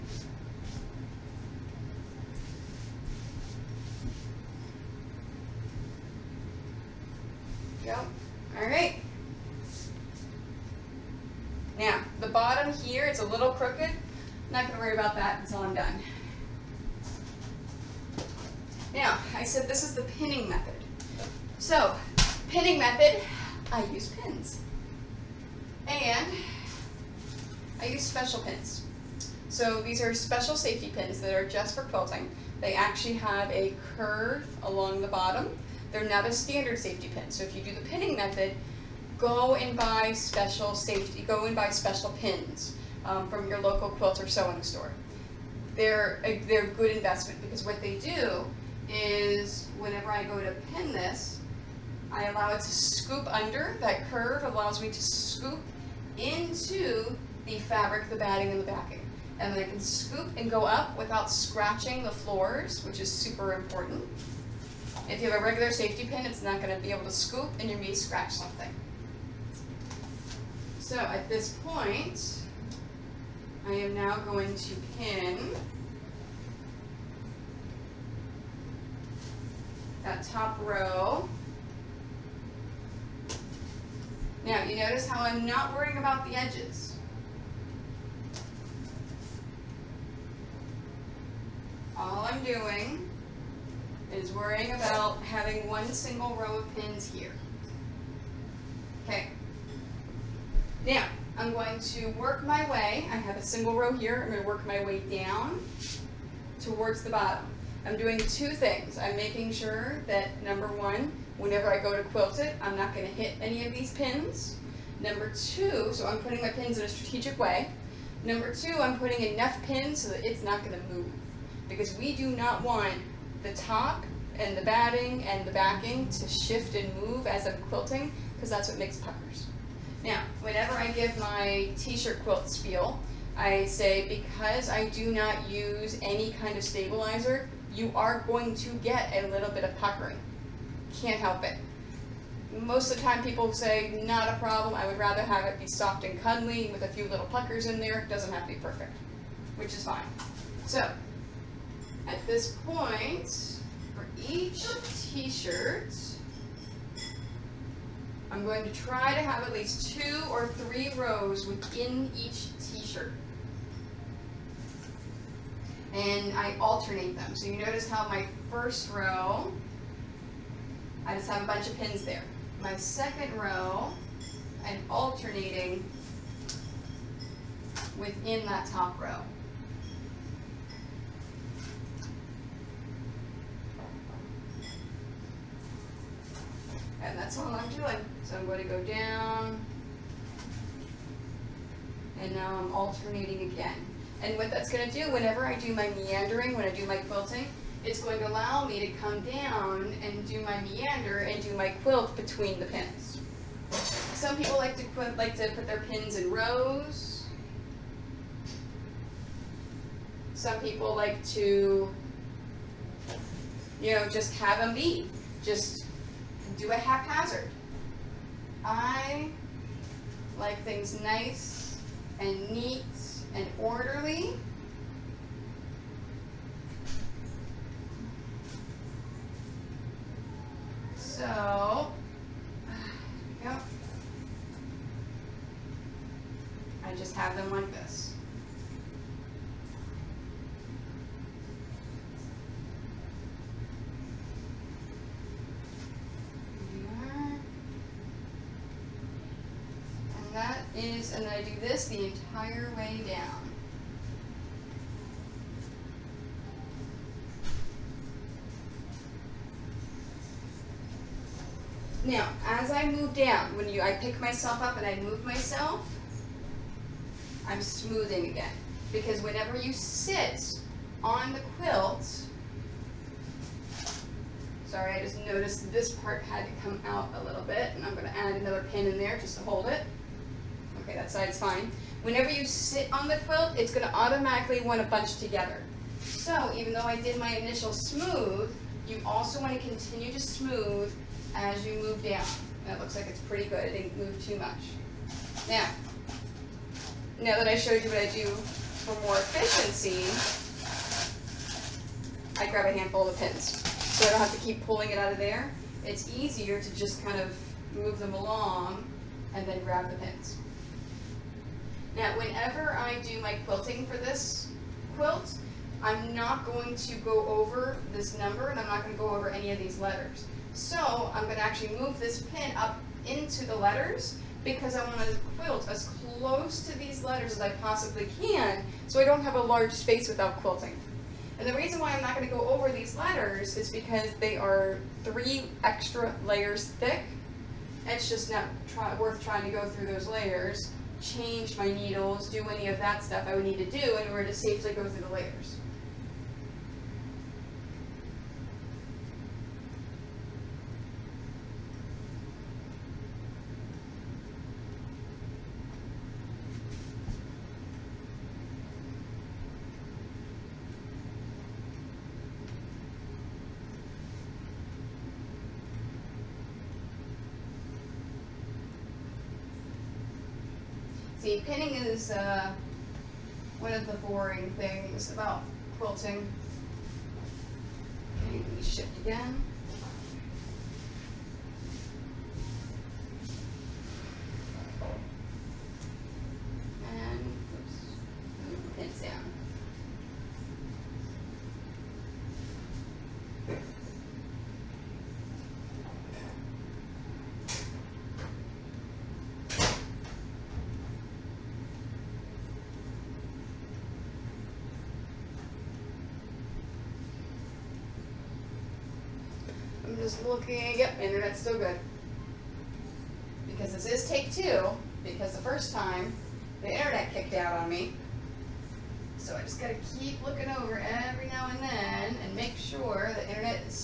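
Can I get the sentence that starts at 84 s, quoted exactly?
Now you notice how I'm not worrying about the edges.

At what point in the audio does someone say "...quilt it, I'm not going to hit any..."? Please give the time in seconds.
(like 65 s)
112 s.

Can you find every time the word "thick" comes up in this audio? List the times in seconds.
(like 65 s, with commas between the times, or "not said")
336 s.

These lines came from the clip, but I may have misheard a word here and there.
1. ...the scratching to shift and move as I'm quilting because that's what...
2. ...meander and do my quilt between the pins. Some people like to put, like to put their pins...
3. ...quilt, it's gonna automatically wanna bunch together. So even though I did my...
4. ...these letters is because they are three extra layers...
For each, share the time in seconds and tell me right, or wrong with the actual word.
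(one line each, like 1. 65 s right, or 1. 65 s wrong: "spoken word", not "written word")
1. 125 s wrong: "backing", not "scratching"
2. 200 s right
3. 283 s right
4. 332 s right.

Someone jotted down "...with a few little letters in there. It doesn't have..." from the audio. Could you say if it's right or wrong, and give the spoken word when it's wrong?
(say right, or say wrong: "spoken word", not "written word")
wrong: "puckers", not "letters".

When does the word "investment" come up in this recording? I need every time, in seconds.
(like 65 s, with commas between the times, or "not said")
46 s.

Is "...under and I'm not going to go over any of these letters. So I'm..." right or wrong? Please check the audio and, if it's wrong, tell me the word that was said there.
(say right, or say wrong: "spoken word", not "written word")
wrong: "number", not "under".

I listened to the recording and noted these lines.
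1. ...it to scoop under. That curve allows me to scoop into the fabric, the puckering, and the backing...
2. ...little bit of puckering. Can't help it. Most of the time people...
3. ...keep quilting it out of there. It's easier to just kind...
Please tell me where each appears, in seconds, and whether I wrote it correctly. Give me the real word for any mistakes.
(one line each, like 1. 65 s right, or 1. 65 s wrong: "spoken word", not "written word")
1. 52 s wrong: "batting", not "puckering"
2. 139 s right
3. 304 s wrong: "pulling", not "quilting".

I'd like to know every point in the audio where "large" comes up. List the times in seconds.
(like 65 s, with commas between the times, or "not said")
329 s.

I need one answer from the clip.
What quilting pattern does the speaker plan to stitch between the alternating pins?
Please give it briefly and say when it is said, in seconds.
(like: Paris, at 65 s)
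Meandering, at 195 s.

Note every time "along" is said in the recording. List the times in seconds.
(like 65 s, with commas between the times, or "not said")
34 s, 308 s.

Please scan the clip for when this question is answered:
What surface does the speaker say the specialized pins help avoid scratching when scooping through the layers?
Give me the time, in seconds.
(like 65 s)
62 s.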